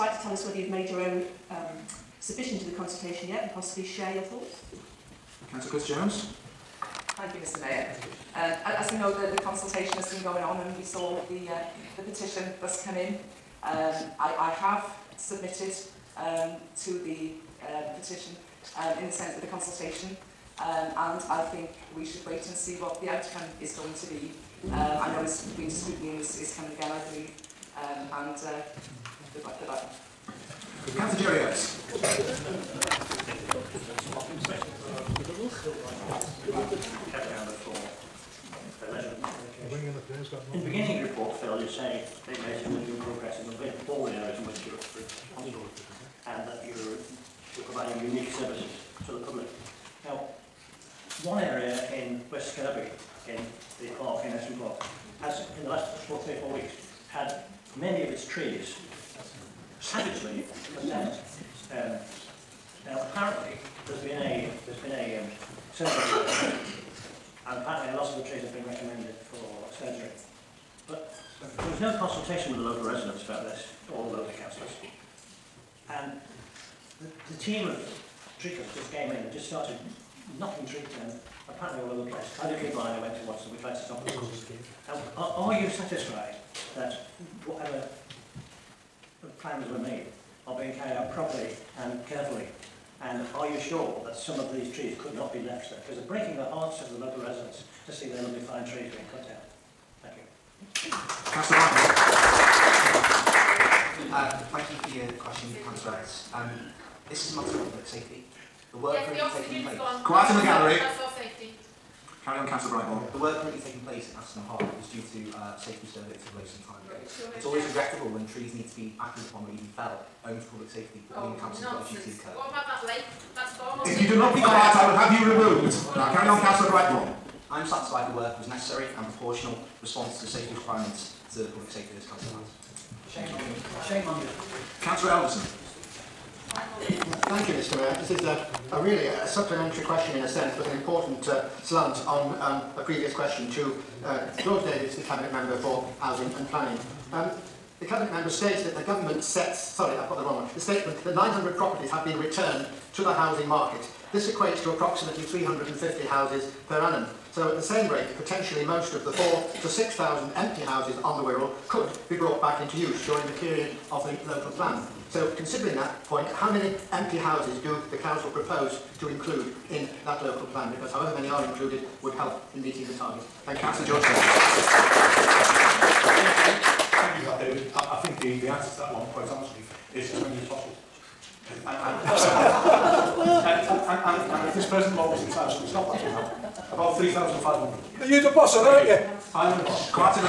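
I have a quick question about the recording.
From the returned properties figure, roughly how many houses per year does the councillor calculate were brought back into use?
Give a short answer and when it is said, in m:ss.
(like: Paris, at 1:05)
350, at 2:35.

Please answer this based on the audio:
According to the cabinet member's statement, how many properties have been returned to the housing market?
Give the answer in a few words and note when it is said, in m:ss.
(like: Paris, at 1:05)
900, at 2:31.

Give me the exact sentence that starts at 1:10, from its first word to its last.
But there was no consultation with the local residents about this, or the local councillors.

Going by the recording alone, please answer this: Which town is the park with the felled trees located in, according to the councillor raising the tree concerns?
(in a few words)
West Kirby.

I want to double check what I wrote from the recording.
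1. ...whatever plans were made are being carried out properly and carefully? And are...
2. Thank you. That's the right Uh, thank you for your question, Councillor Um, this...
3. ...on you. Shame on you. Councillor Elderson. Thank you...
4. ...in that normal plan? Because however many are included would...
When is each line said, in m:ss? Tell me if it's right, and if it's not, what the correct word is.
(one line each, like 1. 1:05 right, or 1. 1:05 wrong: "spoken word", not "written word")
1. 1:27 right
2. 1:40 right
3. 2:13 right
4. 2:49 wrong: "local", not "normal".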